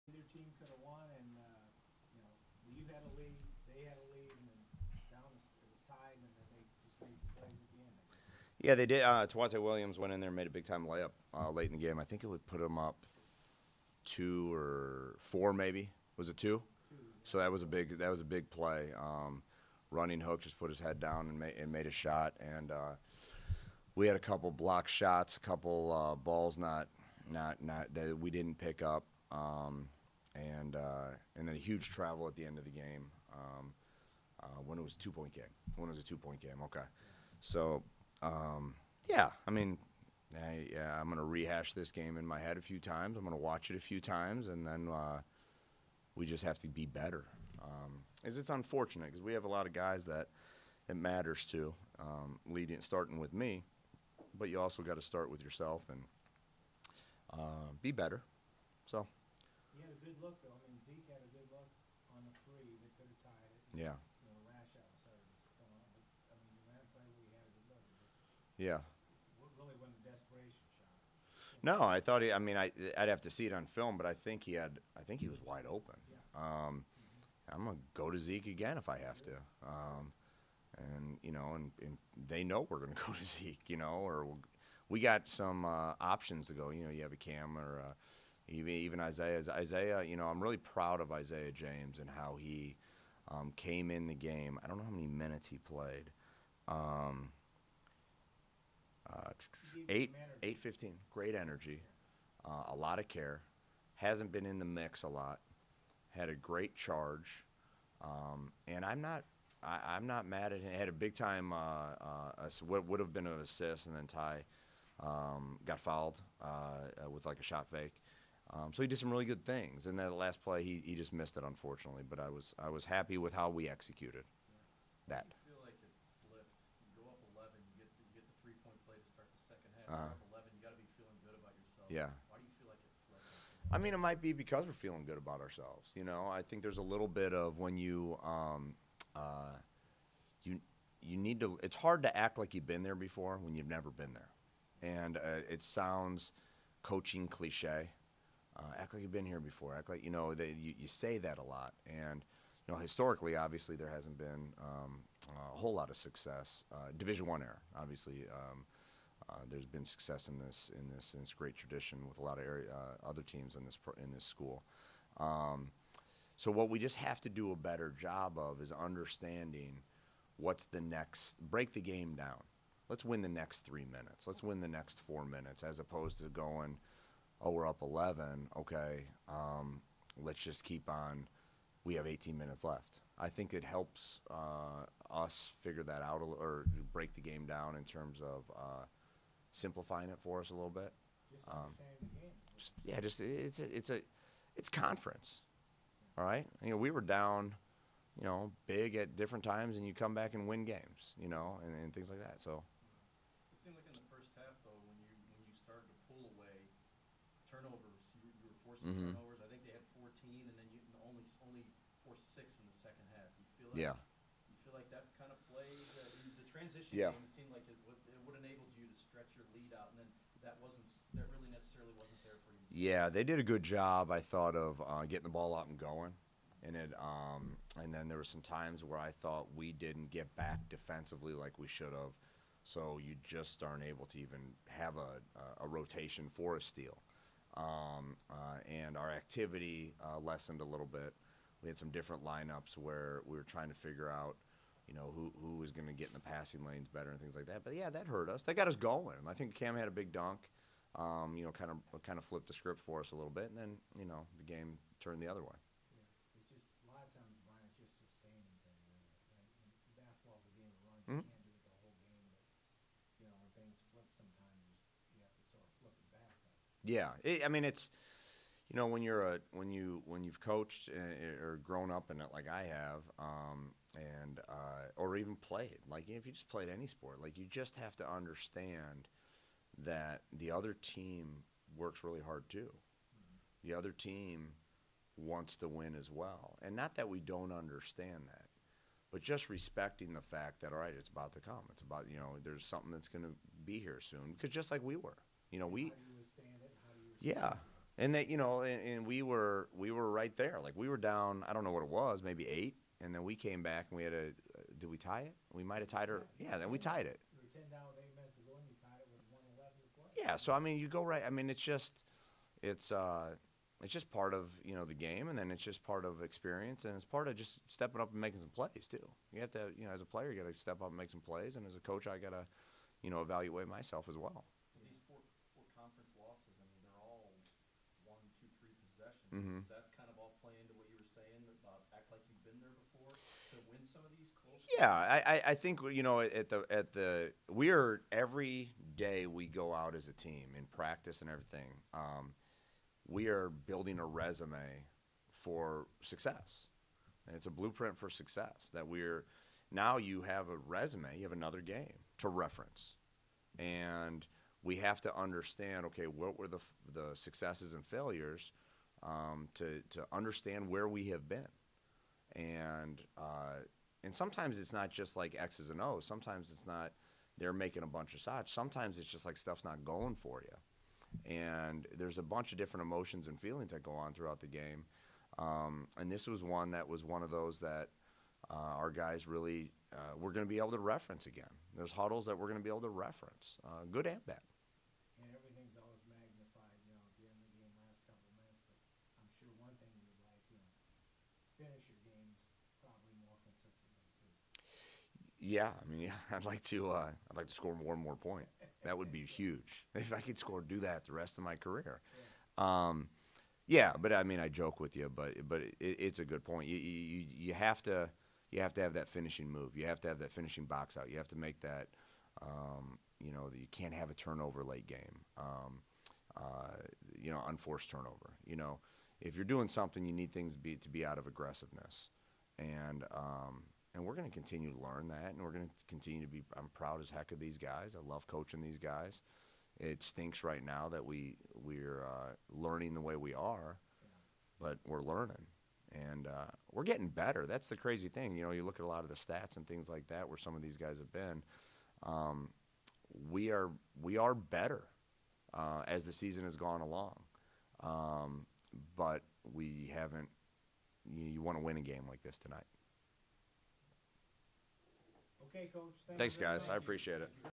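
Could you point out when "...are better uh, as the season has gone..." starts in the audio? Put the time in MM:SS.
07:24.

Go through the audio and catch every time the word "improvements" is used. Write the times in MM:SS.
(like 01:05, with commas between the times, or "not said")
not said.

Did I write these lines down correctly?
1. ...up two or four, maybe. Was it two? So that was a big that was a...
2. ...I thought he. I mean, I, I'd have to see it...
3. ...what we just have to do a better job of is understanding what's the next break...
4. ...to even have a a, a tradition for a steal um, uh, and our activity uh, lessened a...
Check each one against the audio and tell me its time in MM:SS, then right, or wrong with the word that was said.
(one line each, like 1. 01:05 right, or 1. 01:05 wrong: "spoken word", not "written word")
1. 00:12 right
2. 01:11 right
3. 02:46 right
4. 03:54 wrong: "rotation", not "tradition".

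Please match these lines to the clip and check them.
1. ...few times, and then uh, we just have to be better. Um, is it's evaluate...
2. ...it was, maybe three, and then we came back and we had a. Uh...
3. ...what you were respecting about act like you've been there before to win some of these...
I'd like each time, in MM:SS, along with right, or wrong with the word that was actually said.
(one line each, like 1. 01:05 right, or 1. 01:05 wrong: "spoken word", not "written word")
1. 00:43 wrong: "unfortunate", not "evaluate"
2. 05:01 wrong: "eight", not "three"
3. 05:30 wrong: "saying", not "respecting".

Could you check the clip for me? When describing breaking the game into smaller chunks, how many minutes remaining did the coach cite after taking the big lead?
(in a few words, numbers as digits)
18.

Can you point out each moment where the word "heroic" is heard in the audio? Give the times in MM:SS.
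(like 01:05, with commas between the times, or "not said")
not said.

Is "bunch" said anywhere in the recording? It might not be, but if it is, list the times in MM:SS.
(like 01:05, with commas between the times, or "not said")
06:07, 06:12.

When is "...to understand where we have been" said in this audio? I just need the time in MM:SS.
05:59.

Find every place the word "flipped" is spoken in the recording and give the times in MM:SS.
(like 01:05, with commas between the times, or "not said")
02:06, 02:13, 04:12.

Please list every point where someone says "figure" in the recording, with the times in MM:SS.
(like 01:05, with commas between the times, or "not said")
03:05, 04:03.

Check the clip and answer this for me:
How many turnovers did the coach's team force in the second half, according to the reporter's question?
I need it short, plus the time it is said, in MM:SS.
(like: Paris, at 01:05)
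6, at 03:32.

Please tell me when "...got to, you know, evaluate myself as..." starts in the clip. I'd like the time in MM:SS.
05:22.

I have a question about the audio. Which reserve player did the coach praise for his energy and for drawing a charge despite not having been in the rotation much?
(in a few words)
Isaiah James.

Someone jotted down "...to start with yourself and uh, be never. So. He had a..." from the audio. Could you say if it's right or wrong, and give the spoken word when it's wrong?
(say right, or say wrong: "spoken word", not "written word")
wrong: "better", not "never".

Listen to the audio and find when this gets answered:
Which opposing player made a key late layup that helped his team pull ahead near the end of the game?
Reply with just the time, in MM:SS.
00:09.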